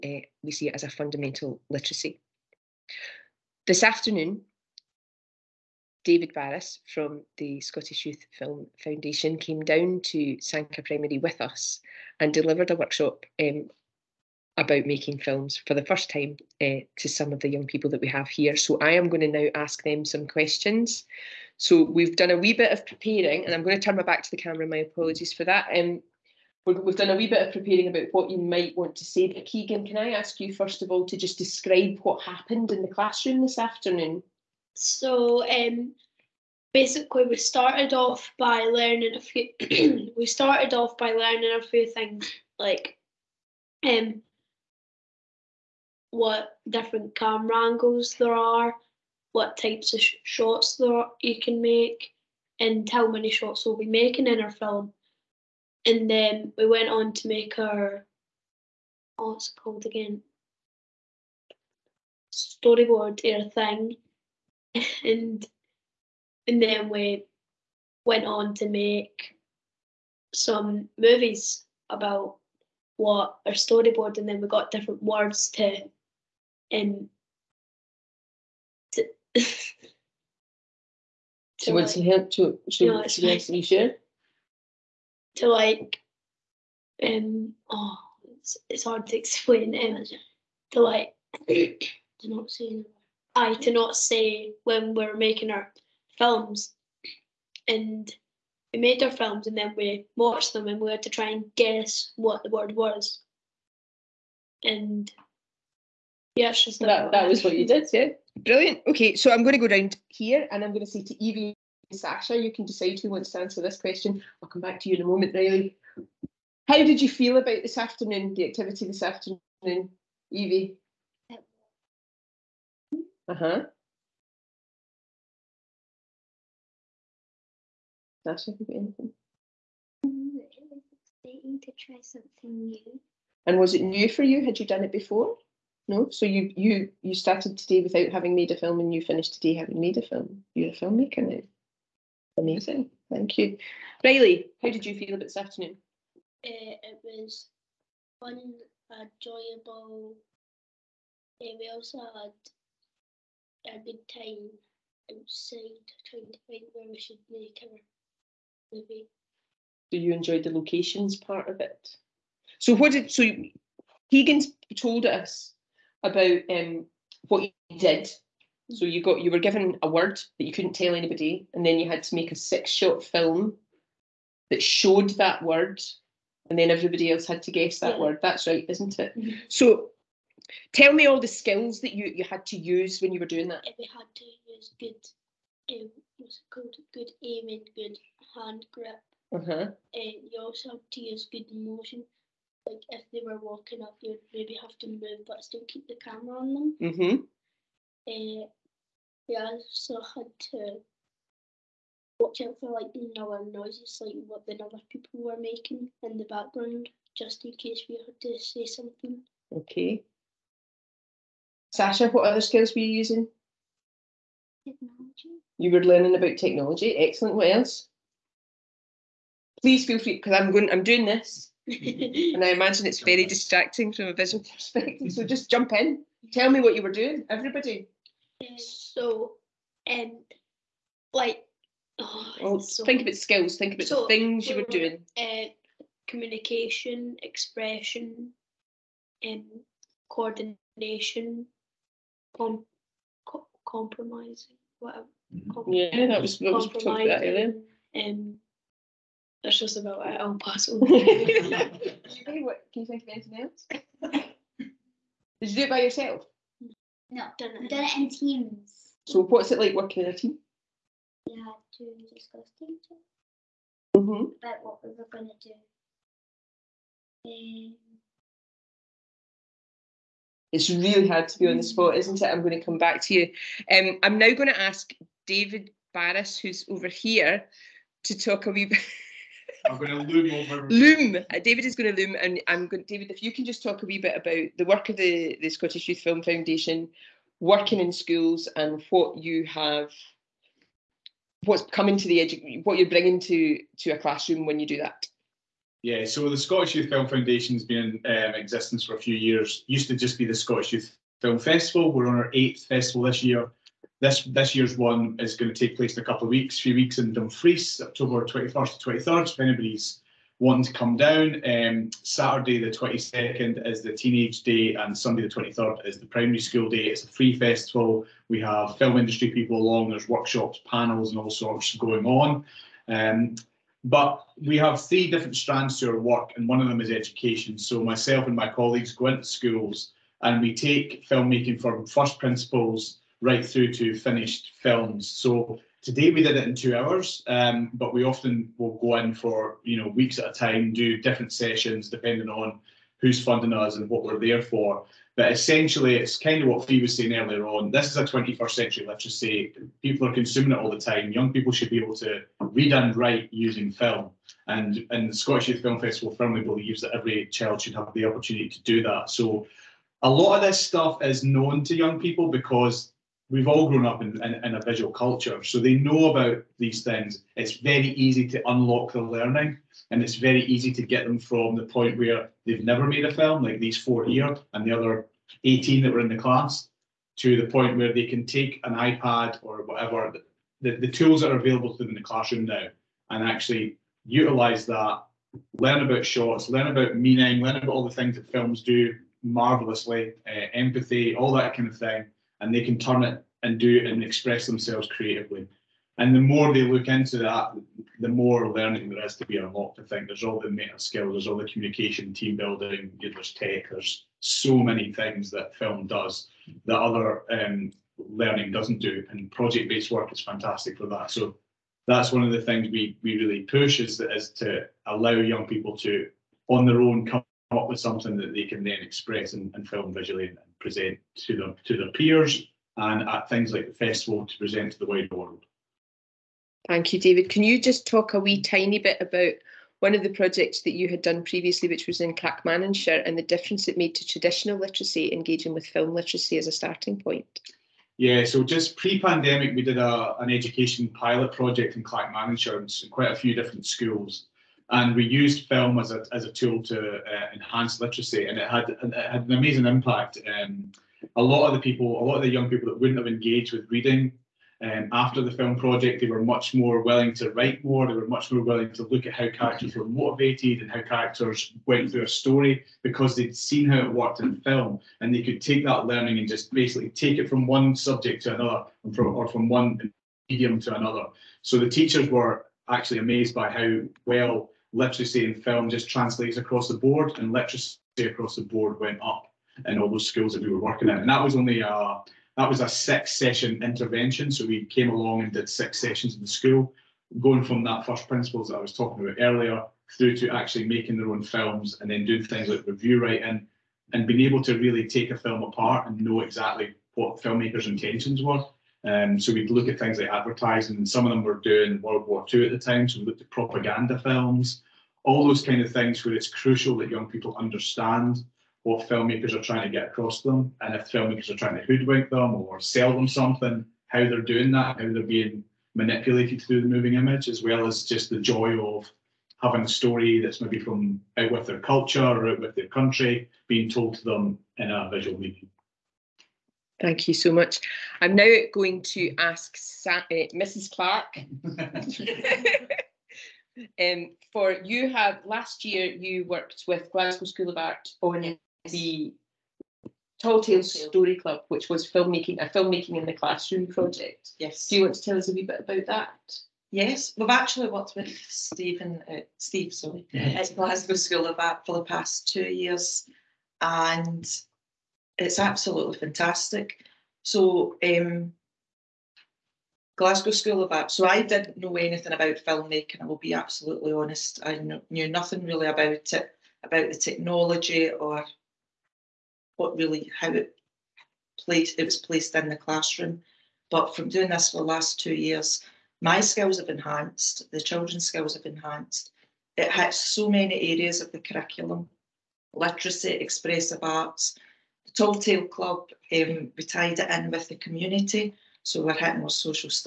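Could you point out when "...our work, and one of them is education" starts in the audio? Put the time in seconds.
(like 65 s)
325 s.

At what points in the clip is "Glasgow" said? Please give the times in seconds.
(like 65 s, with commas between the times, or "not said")
536 s, 550 s, 559 s.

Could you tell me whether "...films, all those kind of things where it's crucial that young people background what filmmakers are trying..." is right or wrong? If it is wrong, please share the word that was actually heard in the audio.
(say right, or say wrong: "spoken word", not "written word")
wrong: "understand", not "background".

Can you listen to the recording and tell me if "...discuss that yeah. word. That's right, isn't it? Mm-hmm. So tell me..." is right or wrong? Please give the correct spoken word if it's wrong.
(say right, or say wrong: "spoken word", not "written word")
wrong: "guess", not "discuss".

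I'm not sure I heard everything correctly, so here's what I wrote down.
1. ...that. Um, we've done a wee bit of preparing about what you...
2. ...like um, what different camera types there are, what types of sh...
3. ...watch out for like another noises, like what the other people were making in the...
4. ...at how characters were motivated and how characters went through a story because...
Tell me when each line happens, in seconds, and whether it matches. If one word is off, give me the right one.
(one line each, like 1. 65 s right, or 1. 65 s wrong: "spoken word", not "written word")
1. 25 s right
2. 42 s wrong: "angles", not "types"
3. 202 s right
4. 459 s right.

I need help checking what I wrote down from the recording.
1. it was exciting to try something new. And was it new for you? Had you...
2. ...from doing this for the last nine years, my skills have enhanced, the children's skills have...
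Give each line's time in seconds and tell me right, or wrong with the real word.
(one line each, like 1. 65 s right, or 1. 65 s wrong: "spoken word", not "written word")
1. 130 s right
2. 573 s wrong: "two", not "nine".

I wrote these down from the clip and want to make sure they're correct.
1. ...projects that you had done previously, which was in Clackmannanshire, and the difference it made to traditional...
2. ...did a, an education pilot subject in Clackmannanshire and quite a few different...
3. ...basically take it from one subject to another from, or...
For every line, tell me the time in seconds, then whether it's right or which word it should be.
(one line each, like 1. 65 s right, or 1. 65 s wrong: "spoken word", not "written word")
1. 430 s right
2. 439 s wrong: "project", not "subject"
3. 466 s right.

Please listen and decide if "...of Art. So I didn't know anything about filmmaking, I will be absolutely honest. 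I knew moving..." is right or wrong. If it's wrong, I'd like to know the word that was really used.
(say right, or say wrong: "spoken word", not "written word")
wrong: "nothing", not "moving".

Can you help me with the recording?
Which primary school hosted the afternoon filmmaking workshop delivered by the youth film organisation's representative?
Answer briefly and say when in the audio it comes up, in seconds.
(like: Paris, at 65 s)
Sanquhar Primary, at 10 s.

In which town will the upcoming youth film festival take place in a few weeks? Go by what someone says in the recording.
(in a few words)
Dumfries.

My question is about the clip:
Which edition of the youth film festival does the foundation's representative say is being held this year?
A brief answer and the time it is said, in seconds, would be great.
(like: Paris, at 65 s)
8th, at 302 s.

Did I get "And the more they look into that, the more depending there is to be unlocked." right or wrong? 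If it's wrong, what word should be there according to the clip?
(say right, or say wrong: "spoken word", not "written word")
wrong: "learning", not "depending".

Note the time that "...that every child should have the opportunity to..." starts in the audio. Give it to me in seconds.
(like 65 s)
356 s.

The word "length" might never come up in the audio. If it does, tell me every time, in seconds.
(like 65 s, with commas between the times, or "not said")
not said.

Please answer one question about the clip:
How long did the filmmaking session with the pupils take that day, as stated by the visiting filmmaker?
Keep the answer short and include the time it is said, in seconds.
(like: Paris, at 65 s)
2 hours, at 336 s.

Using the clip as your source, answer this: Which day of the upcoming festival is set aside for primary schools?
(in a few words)
Sunday the 23rd.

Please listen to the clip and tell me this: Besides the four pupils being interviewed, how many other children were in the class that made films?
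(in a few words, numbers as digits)
18.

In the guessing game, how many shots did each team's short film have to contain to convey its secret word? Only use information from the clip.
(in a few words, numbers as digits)
6.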